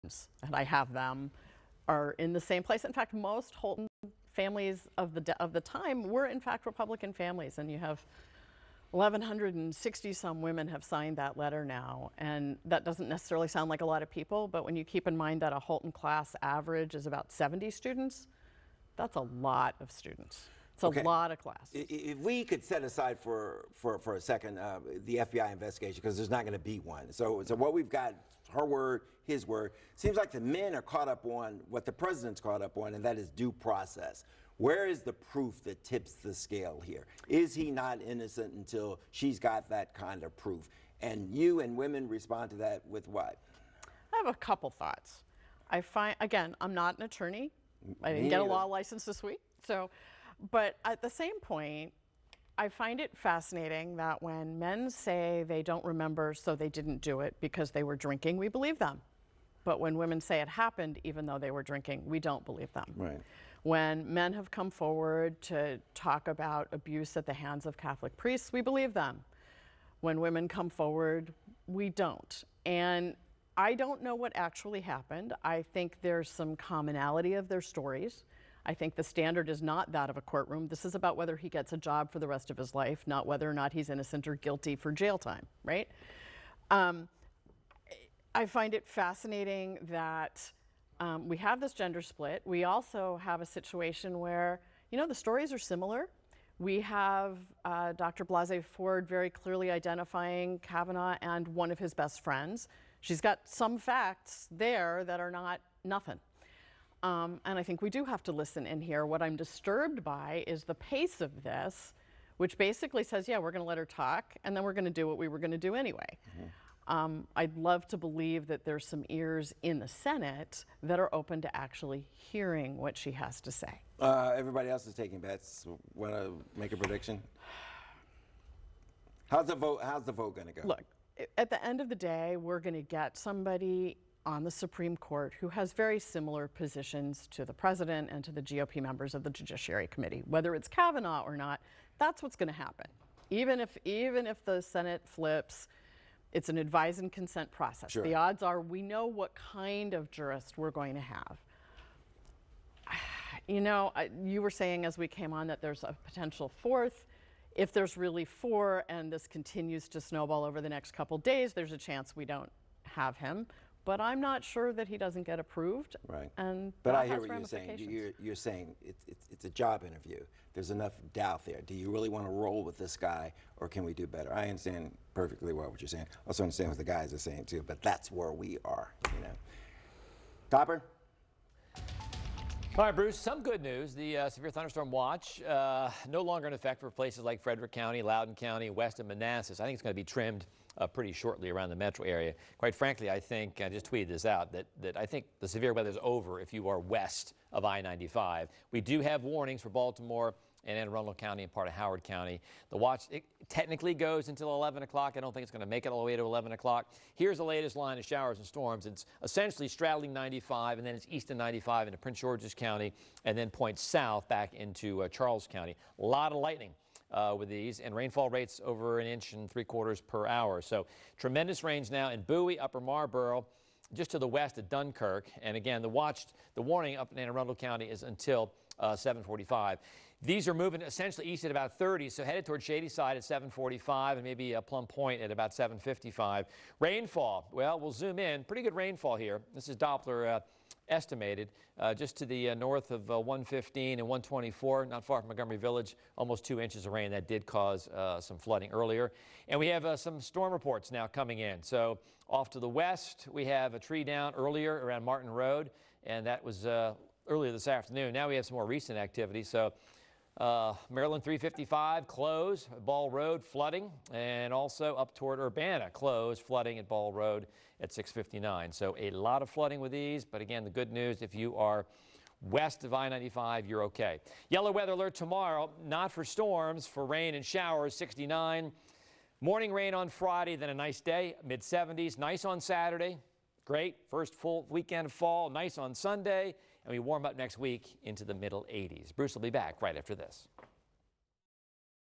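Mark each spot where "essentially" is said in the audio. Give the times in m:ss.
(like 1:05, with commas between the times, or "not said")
3:29, 3:50.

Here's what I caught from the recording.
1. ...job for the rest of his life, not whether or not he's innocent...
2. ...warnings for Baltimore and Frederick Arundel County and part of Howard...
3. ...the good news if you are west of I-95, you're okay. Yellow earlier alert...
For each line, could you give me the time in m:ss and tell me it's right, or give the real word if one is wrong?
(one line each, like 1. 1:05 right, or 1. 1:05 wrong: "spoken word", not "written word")
1. 1:21 right
2. 3:19 wrong: "Anne", not "Frederick"
3. 4:30 wrong: "weather", not "earlier".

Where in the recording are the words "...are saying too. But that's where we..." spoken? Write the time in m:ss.
2:57.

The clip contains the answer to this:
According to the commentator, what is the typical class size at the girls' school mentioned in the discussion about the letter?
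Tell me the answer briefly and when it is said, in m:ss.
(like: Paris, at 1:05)
70 students, at 0:17.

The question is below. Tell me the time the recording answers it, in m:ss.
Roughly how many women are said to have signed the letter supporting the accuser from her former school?
0:08.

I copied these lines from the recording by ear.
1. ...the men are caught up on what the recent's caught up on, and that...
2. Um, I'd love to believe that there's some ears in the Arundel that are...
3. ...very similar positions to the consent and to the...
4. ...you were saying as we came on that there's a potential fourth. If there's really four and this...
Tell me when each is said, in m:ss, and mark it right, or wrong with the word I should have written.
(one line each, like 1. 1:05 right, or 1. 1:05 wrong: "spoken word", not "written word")
1. 0:30 wrong: "president", not "recent"
2. 1:56 wrong: "Senate", not "Arundel"
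3. 2:15 wrong: "president", not "consent"
4. 2:34 right.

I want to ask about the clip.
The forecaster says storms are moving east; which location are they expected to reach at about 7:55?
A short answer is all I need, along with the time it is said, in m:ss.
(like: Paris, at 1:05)
Plum Point, at 3:54.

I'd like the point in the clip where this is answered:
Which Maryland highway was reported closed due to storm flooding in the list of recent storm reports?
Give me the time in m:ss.
4:20.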